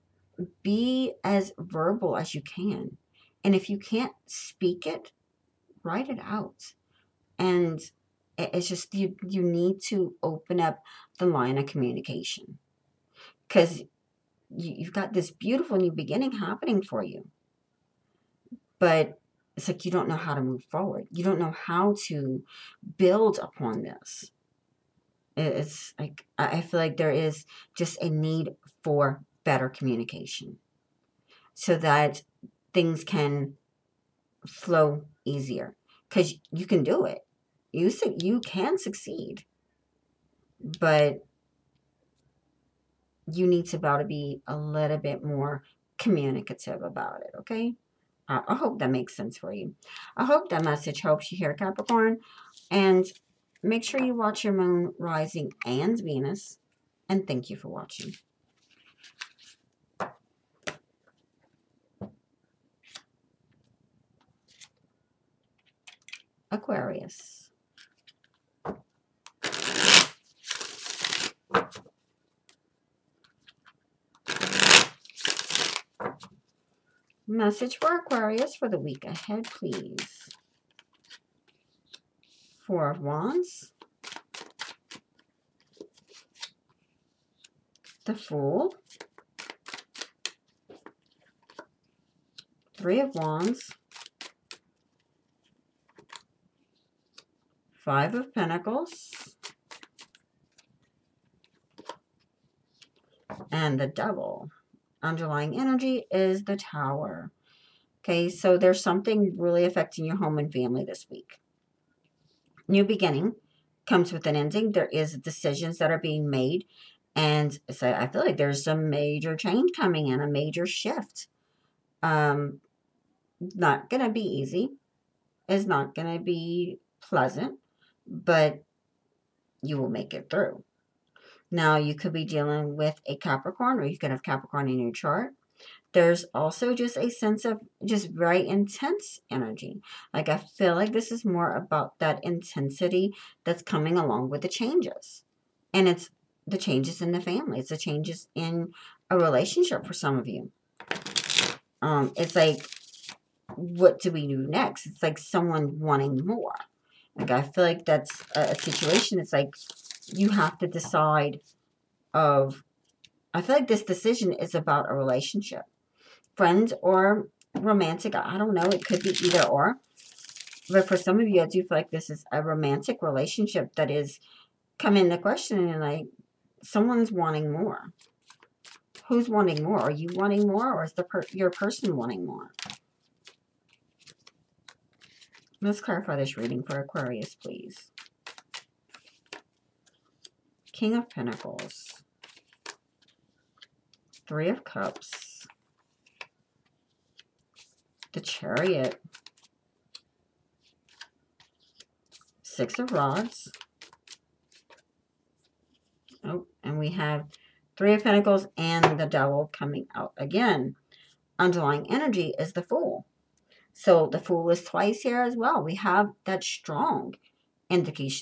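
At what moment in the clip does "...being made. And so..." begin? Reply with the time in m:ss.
1:55.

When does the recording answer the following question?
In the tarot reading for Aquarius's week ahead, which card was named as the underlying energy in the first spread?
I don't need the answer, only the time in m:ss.
1:46.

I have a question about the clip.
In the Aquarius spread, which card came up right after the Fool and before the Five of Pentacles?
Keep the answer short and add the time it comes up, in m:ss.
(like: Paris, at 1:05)
Three of Wands, at 1:32.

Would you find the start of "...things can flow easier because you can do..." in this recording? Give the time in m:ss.
0:32.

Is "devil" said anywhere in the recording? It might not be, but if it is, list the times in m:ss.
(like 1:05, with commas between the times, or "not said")
1:43, 3:29.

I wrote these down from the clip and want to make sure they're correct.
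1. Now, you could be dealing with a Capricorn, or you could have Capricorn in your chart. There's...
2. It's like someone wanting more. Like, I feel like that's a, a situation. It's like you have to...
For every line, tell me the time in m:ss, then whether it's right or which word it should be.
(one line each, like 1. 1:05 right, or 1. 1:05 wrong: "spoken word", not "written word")
1. 2:11 right
2. 2:34 right.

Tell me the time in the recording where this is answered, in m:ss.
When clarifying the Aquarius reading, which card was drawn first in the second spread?
3:10.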